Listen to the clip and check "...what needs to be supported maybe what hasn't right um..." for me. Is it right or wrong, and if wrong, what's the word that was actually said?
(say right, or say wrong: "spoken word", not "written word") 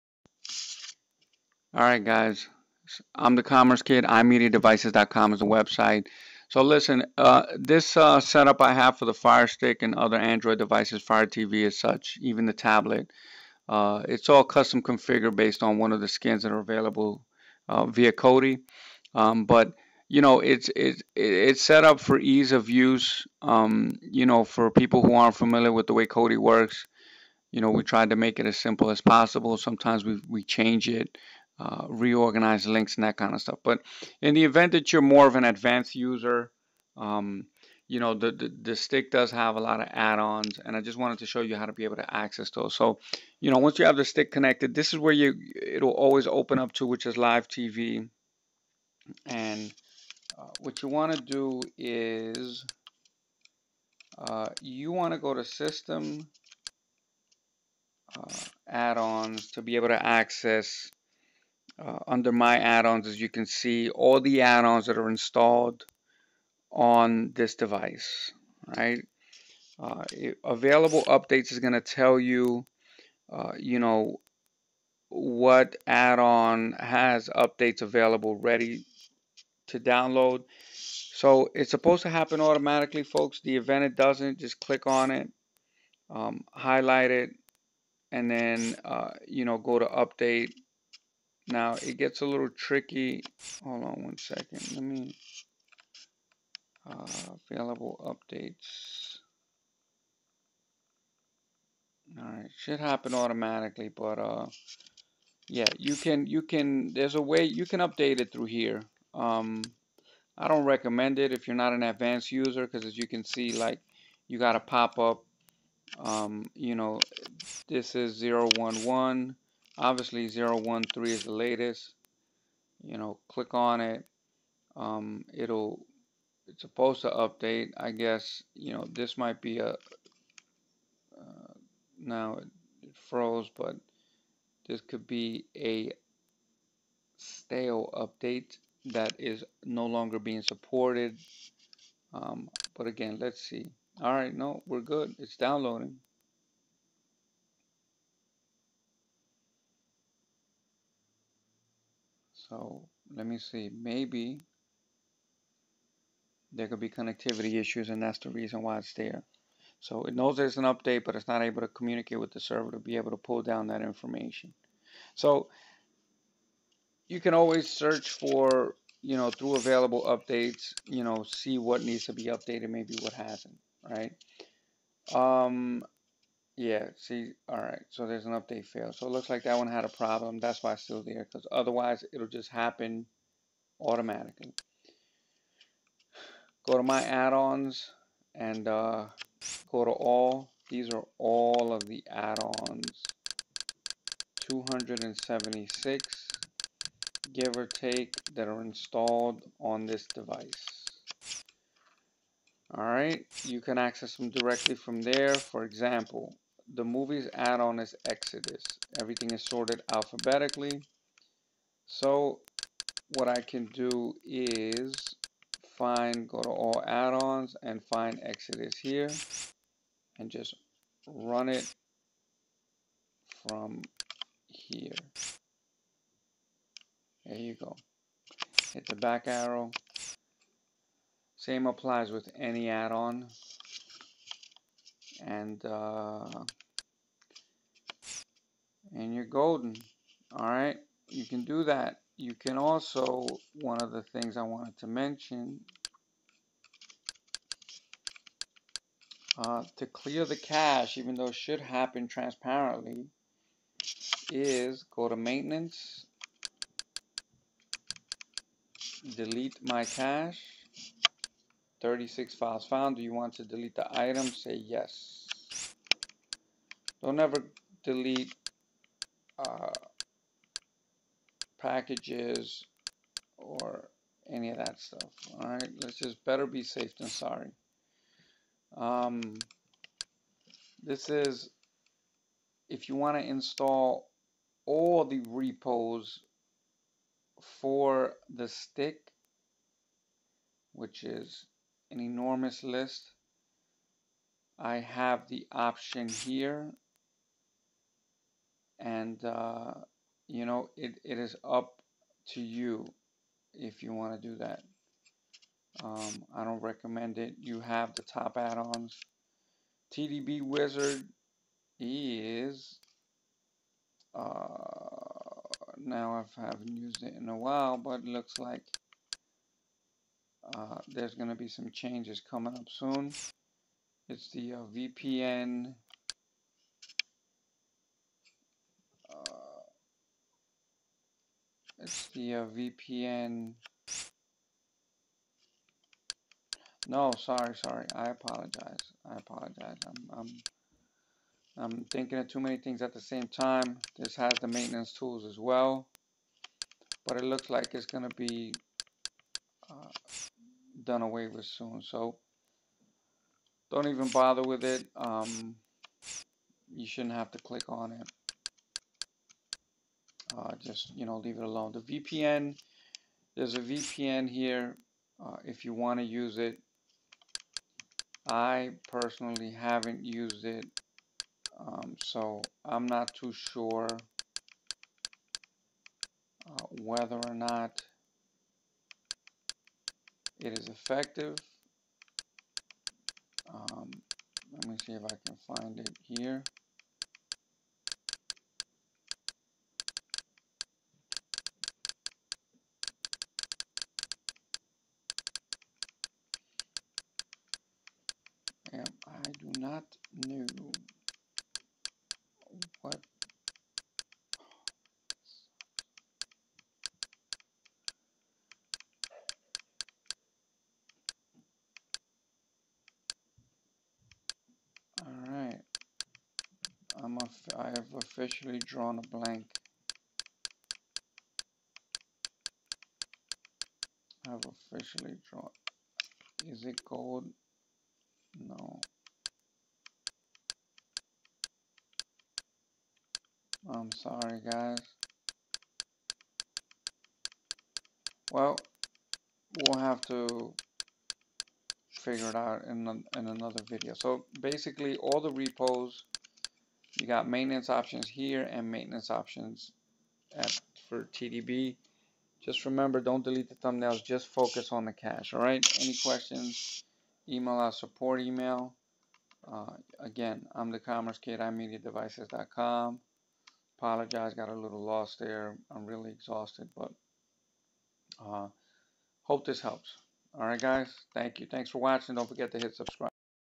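wrong: "updated", not "supported".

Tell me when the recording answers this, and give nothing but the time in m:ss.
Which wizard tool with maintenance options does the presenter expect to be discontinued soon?
5:09.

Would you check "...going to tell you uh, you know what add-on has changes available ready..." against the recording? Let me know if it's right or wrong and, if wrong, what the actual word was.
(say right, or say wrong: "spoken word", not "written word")
wrong: "updates", not "changes".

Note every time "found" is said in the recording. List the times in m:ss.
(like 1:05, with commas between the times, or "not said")
4:22.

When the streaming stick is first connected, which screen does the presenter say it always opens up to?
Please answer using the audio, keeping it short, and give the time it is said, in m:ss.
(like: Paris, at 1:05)
Live TV, at 0:47.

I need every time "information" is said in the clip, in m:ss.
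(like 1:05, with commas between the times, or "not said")
2:43.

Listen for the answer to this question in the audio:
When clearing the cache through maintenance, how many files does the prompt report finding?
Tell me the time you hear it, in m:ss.
4:21.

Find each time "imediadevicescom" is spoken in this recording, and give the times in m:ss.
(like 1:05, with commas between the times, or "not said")
0:04, 7:41.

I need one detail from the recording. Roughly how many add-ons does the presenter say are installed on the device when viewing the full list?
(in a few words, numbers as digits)
276.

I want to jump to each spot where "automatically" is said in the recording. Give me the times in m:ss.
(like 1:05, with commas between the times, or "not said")
1:22, 1:43, 3:03.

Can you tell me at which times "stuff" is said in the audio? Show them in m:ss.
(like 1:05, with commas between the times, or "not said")
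0:33, 4:34.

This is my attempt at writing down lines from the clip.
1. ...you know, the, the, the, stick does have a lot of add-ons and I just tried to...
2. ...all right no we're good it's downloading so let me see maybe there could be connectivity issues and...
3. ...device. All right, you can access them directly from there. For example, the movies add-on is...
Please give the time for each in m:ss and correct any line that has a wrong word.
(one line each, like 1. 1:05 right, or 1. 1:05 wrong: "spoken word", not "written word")
1. 0:37 wrong: "wanted", not "tried"
2. 2:24 right
3. 3:20 right.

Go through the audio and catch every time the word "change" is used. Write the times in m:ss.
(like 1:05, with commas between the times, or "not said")
0:30, 5:21.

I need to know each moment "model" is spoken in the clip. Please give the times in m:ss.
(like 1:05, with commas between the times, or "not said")
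not said.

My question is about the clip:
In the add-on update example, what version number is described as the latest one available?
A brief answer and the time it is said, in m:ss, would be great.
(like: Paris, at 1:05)
013, at 2:00.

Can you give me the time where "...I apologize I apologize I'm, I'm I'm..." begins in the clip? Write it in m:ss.
5:37.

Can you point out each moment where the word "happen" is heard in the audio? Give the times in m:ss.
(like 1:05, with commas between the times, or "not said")
1:22, 1:42, 3:02, 4:11.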